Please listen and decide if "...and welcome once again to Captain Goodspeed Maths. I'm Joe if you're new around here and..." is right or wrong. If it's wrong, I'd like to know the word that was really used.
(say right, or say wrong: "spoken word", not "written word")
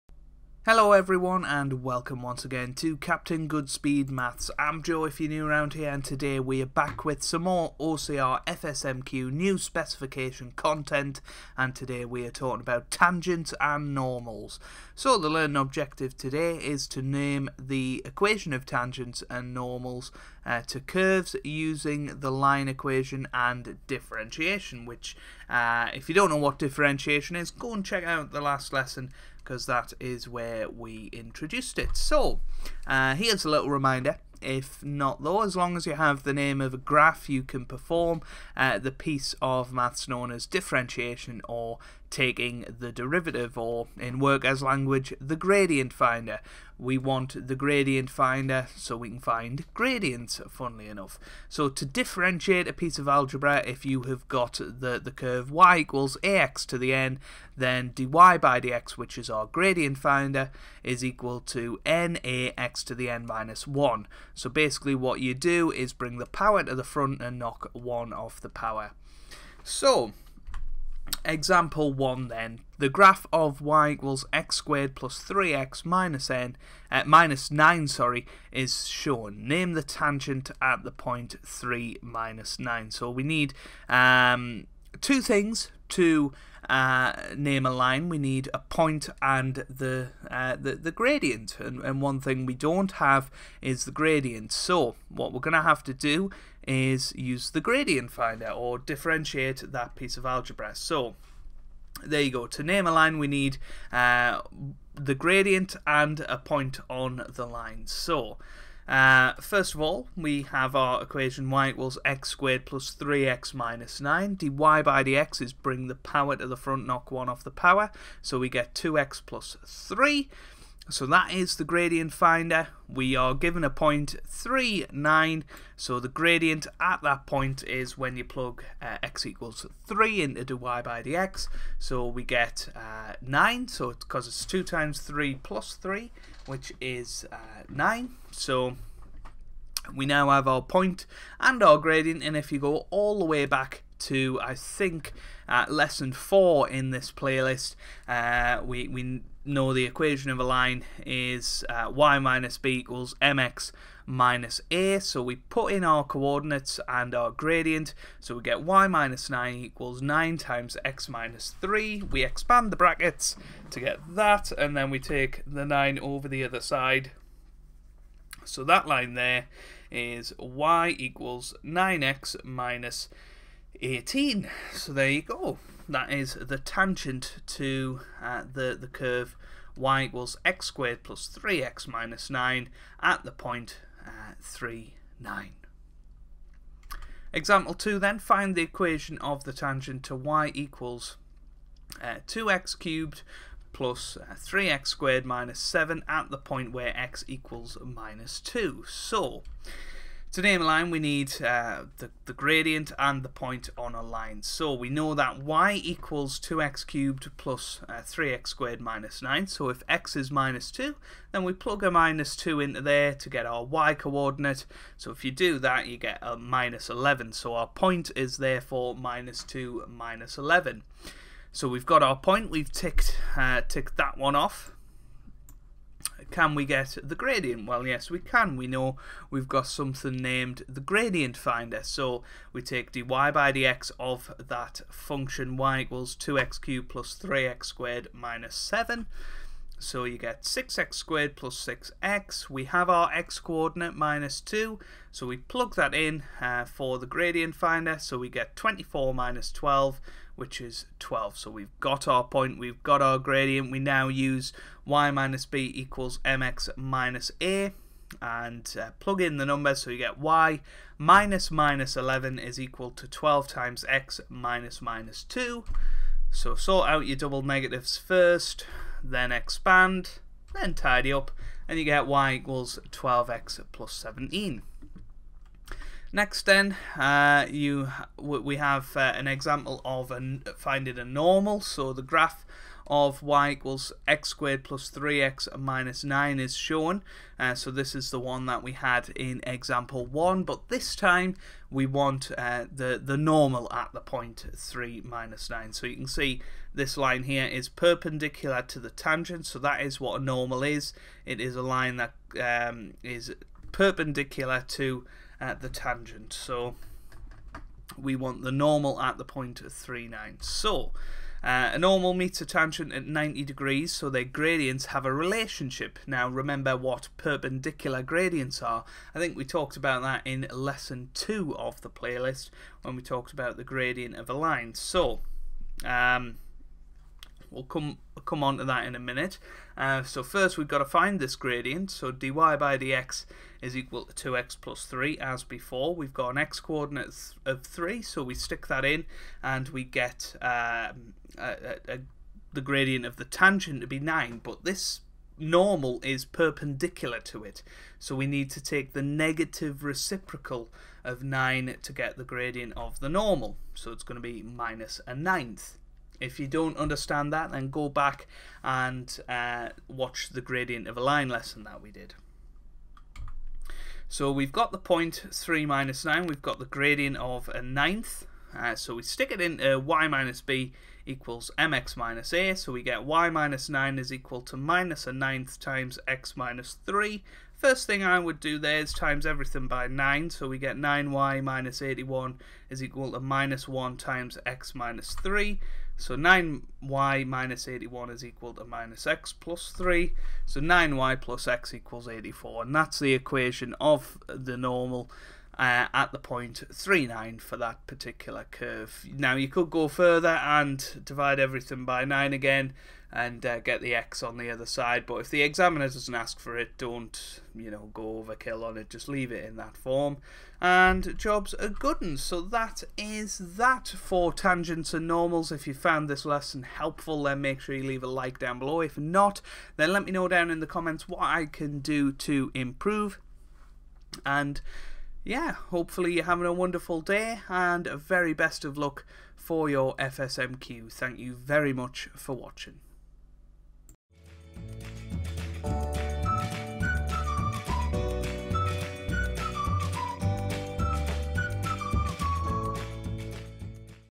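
right.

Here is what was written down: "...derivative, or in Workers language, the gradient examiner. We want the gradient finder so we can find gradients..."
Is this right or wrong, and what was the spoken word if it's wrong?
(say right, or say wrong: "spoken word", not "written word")
wrong: "finder", not "examiner".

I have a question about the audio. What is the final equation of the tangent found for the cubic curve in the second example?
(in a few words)
y = 12x + 17.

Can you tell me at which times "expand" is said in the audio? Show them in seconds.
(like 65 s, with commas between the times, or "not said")
162 s, 269 s.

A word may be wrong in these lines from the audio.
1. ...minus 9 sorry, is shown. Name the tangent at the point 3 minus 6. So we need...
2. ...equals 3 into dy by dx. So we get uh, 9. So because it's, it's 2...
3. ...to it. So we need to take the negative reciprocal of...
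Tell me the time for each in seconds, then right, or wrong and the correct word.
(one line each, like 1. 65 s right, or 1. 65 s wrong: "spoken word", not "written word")
1. 77 s wrong: "9", not "6"
2. 129 s right
3. 347 s right.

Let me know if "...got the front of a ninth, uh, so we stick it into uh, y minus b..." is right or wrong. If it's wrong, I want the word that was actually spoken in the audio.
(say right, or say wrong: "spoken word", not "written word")
wrong: "gradient", not "front".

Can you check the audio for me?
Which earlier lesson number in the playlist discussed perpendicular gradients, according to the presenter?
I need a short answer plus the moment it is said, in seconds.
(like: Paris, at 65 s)
2, at 320 s.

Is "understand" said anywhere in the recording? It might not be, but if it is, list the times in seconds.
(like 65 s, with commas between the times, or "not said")
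356 s.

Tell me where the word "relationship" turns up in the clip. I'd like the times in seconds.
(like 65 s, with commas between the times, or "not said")
315 s.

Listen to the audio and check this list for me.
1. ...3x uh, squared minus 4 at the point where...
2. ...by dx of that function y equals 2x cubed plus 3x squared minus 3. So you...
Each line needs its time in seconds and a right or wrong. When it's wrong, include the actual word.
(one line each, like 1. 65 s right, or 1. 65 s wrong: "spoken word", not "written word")
1. 194 s wrong: "7", not "4"
2. 233 s wrong: "7", not "3".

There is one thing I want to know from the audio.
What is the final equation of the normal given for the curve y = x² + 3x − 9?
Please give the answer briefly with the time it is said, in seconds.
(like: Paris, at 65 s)
9y + x = 84, at 390 s.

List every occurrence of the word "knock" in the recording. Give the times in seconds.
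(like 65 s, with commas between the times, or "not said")
67 s, 116 s.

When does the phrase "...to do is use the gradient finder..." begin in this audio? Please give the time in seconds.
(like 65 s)
95 s.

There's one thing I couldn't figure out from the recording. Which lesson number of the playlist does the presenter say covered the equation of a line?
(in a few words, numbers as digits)
4.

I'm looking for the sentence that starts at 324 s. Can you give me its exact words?
So, um, We'll come come on to that in a minute.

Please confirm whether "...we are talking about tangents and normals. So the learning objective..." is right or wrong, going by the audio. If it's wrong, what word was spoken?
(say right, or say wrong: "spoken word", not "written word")
right.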